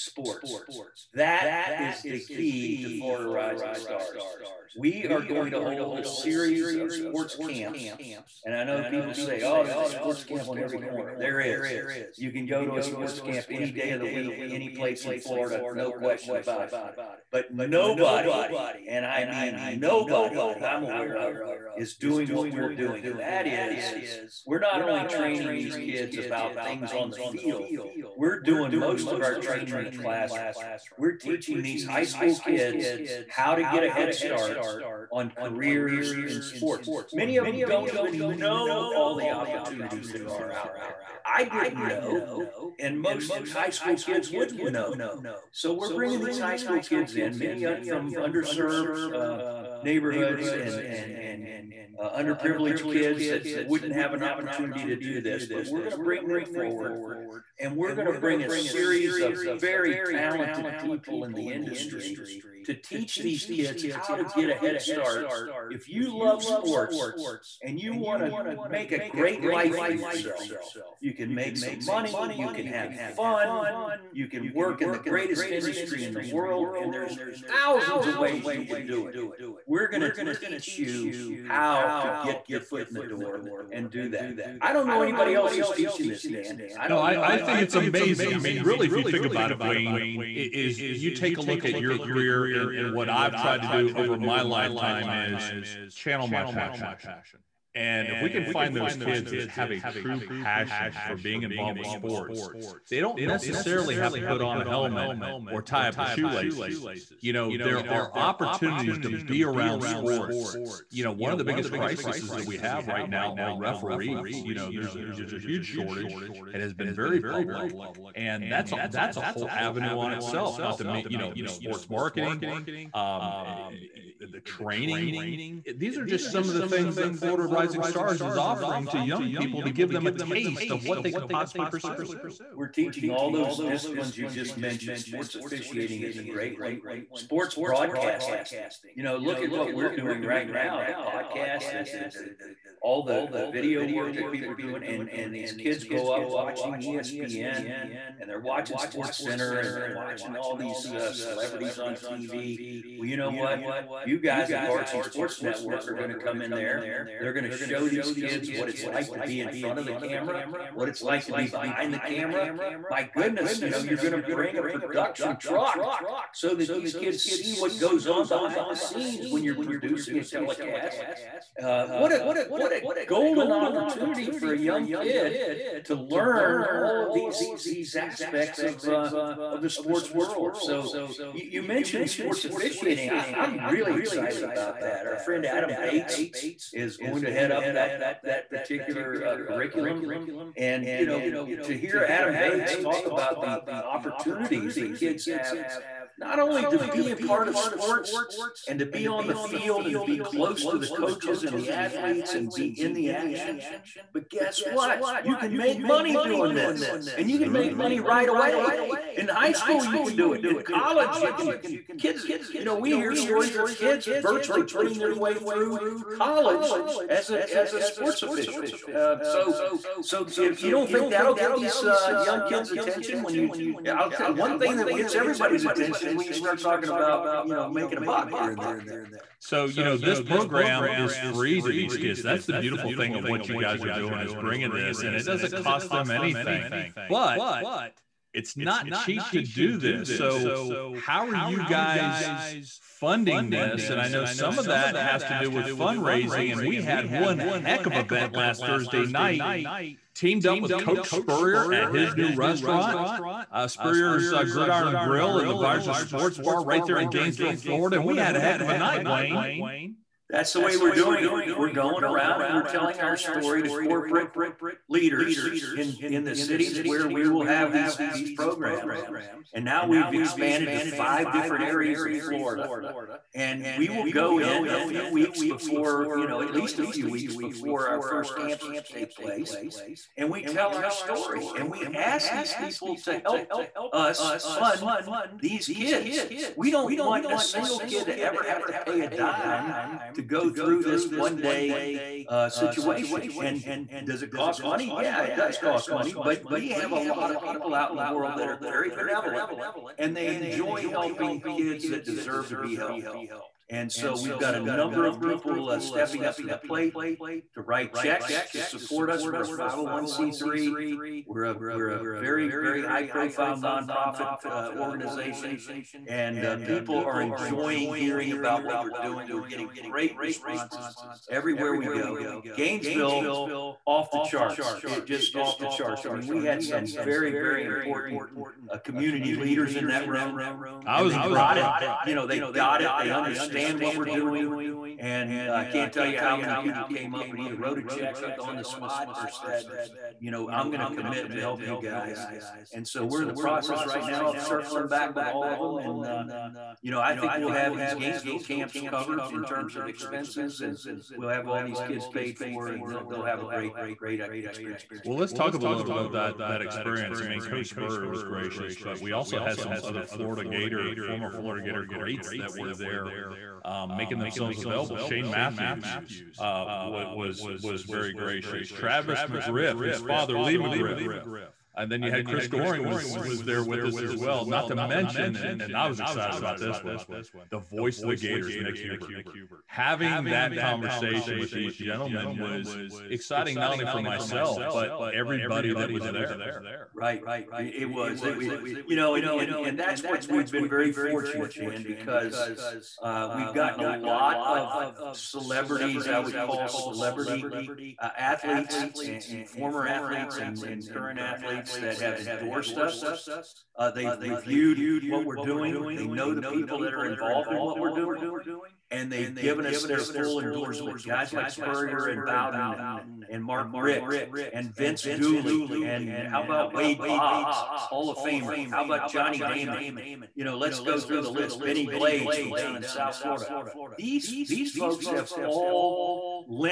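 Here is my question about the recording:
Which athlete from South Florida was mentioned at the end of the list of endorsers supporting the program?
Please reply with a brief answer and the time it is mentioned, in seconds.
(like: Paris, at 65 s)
Bennie Blades, at 421 s.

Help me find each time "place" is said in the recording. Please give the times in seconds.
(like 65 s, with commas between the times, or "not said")
14 s, 279 s.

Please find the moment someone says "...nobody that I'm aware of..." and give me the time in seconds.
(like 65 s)
19 s.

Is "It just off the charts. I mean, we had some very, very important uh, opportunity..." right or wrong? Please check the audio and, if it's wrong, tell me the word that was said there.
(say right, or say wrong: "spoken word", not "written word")
wrong: "community", not "opportunity".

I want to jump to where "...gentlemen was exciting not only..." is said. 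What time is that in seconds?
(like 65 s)
381 s.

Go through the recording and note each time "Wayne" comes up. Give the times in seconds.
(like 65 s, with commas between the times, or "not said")
89 s, 259 s.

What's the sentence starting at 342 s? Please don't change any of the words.
And so we're in the process right now of circling back with all of them.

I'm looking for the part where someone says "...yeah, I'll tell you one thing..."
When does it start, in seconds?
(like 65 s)
223 s.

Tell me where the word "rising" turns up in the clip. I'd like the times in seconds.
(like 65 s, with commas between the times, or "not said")
3 s, 127 s.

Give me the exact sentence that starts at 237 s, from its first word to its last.
But it's not cheap to do this.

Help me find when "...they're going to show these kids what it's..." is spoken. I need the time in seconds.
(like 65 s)
157 s.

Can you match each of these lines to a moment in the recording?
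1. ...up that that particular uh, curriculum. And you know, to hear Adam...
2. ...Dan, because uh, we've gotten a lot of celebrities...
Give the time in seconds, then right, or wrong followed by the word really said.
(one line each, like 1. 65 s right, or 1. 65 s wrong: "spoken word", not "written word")
1. 187 s right
2. 391 s right.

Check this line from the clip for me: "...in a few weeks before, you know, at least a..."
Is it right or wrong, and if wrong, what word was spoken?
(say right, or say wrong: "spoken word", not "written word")
right.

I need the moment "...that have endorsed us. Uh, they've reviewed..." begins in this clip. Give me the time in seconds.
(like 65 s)
401 s.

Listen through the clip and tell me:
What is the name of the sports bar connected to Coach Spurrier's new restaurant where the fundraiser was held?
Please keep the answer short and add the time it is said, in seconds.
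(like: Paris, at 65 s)
Visor Sports Bar, at 255 s.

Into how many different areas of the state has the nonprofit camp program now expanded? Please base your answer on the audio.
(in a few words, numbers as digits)
5.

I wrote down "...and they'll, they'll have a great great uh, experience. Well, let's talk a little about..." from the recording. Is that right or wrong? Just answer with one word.
right.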